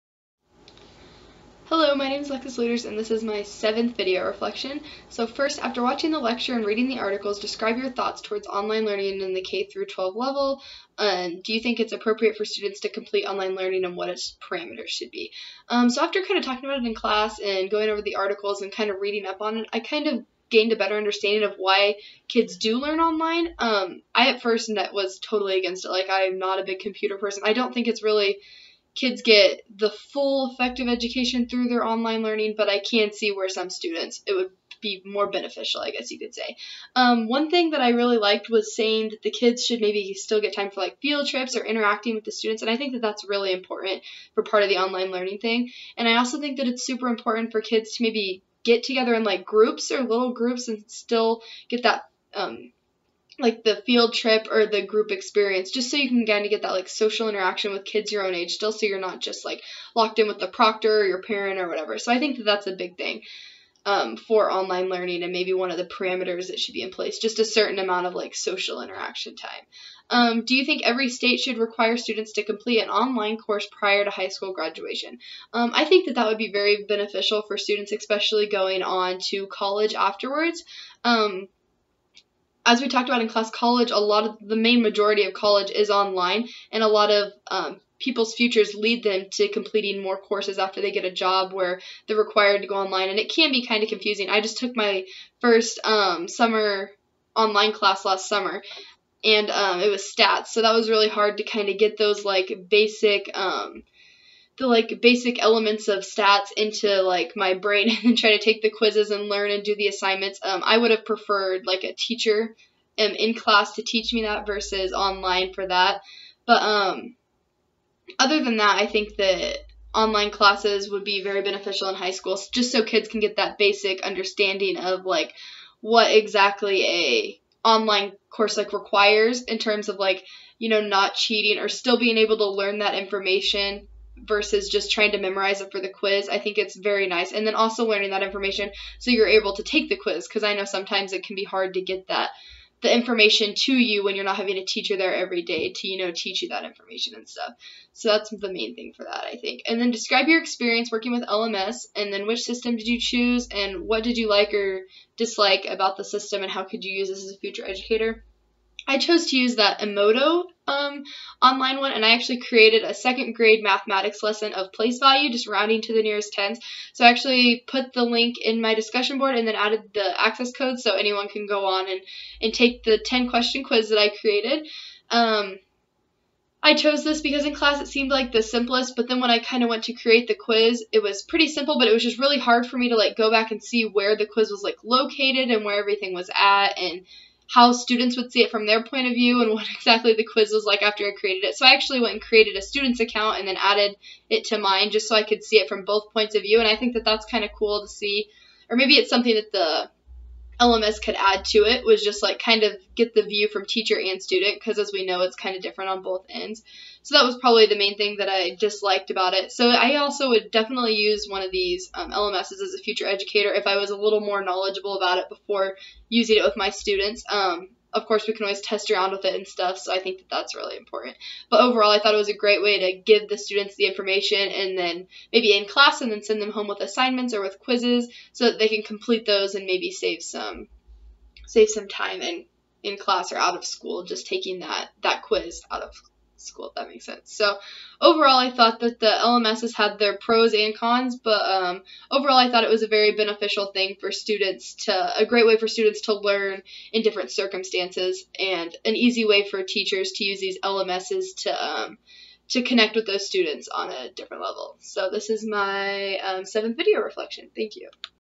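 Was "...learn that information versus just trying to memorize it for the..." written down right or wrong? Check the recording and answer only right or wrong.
right.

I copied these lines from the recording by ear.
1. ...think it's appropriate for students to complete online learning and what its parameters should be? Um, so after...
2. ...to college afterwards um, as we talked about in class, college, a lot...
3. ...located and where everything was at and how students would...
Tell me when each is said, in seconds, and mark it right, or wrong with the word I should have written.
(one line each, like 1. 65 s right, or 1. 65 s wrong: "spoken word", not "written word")
1. 11 s right
2. 79 s right
3. 184 s right.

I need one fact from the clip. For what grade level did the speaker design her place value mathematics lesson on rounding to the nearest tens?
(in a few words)
second grade.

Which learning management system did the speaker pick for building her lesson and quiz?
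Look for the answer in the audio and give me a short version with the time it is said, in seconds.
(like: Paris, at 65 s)
Edmodo, at 159 s.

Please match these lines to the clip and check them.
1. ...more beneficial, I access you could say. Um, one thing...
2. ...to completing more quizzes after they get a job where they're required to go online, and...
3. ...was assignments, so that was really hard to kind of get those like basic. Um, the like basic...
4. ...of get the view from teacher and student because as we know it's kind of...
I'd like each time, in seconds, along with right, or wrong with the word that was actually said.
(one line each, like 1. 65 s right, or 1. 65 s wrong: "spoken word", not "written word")
1. 35 s wrong: "guess", not "access"
2. 89 s wrong: "courses", not "quizzes"
3. 99 s wrong: "stats", not "assignments"
4. 202 s right.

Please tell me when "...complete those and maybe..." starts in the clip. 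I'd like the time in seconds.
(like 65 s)
228 s.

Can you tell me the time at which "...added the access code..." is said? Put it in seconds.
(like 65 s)
169 s.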